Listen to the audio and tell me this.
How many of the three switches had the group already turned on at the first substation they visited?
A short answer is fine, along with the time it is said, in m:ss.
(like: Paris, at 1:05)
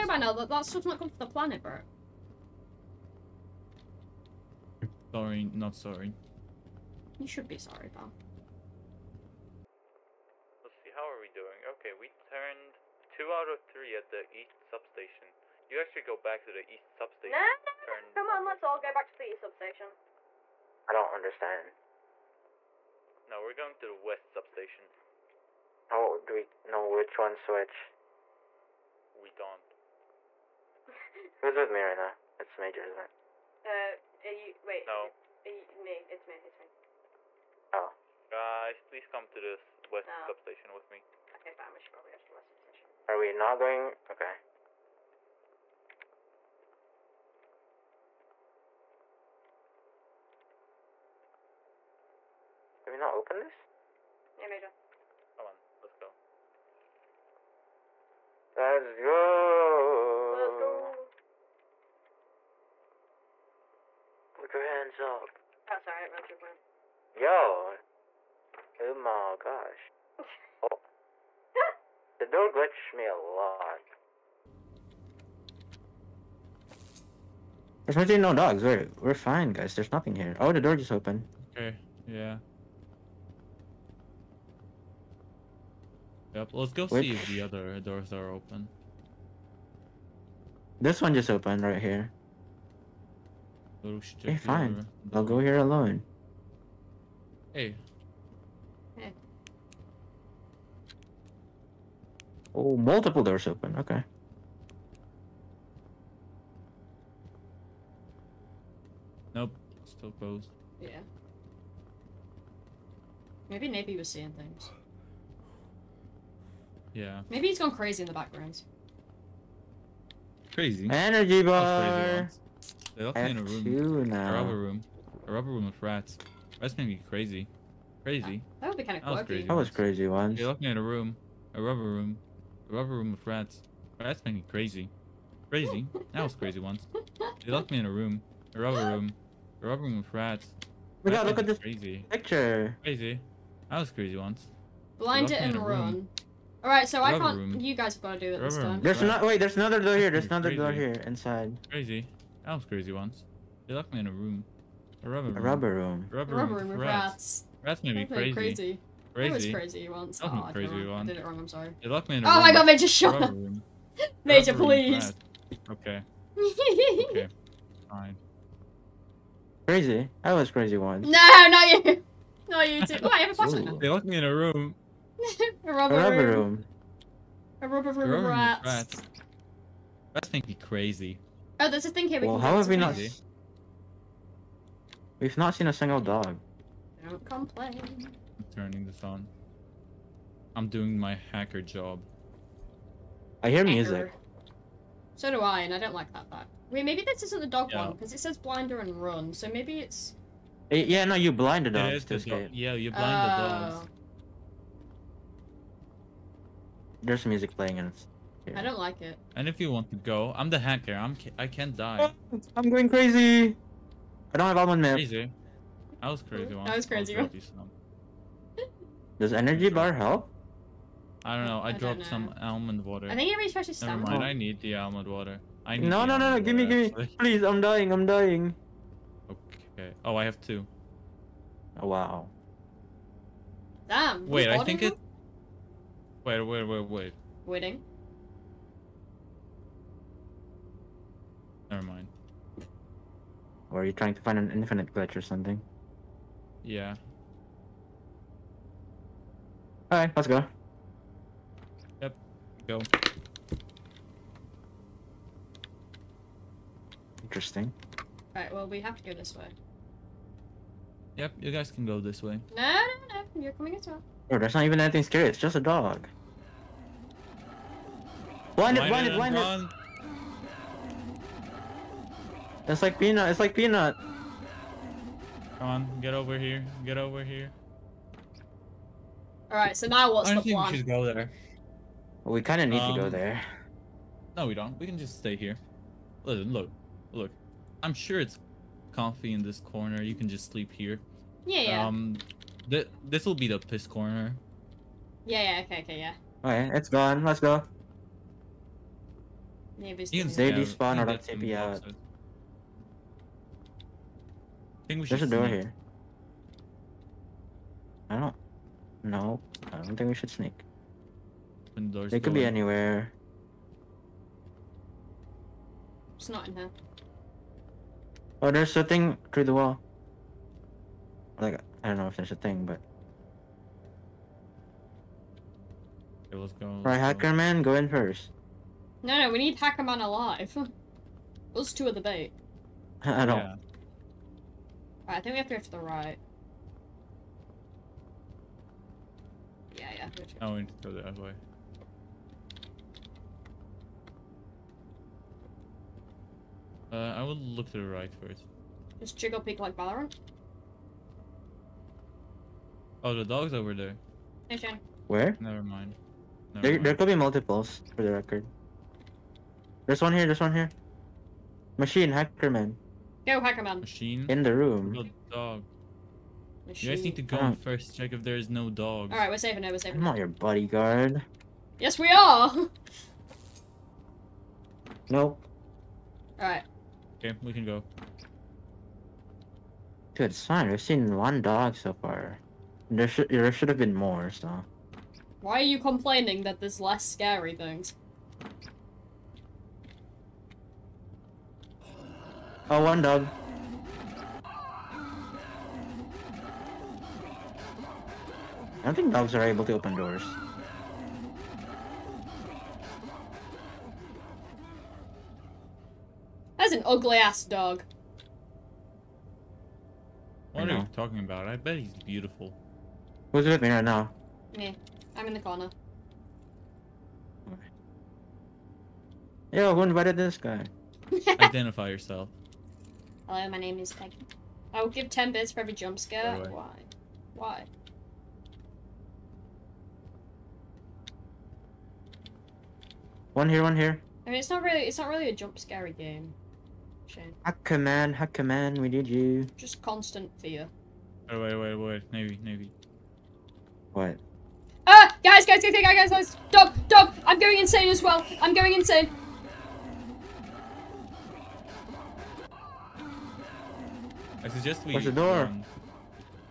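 2, at 0:13.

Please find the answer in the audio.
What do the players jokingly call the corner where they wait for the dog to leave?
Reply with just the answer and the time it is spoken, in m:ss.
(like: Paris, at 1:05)
the piss corner, at 4:53.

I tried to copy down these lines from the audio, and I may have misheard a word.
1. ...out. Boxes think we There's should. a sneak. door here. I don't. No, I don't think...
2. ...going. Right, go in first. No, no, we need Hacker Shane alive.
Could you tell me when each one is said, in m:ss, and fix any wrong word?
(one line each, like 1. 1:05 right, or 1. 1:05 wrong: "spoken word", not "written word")
1. 5:01 right
2. 5:26 wrong: "Man", not "Shane".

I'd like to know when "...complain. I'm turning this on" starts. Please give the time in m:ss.
3:07.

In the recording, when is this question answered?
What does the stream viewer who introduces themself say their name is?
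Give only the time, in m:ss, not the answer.
7:03.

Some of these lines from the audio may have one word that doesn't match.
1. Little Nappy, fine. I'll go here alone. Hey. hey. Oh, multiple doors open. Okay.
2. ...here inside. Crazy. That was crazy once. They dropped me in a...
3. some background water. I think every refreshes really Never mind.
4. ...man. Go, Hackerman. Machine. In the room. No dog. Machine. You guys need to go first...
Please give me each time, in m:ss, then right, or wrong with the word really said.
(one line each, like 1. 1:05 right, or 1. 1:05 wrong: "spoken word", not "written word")
1. 1:33 wrong: "Hey", not "Nappy"
2. 2:30 wrong: "locked", not "dropped"
3. 3:42 wrong: "almond", not "background"
4. 6:02 right.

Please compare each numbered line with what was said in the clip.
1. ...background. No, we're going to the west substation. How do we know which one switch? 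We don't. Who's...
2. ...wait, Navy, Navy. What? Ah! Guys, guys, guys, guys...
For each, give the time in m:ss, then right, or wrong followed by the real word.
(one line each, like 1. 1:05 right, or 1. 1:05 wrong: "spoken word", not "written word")
1. 0:21 wrong: "understand", not "background"
2. 7:21 right.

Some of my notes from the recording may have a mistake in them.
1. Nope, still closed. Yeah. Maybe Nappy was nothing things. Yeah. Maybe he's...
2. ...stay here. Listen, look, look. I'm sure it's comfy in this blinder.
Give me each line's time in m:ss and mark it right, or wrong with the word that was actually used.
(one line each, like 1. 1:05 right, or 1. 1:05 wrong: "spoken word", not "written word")
1. 1:49 wrong: "seeing", not "nothing"
2. 4:45 wrong: "corner", not "blinder".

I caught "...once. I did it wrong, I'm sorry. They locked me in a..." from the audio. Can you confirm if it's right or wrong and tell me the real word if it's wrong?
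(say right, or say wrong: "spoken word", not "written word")
right.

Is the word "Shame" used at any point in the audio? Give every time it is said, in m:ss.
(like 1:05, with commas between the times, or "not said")
7:17.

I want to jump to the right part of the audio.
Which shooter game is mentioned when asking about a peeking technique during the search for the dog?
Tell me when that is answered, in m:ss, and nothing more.
5:49.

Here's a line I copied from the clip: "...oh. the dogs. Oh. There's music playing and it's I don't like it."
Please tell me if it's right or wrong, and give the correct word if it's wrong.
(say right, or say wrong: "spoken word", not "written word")
right.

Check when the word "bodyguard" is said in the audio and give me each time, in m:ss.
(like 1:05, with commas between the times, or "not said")
6:10.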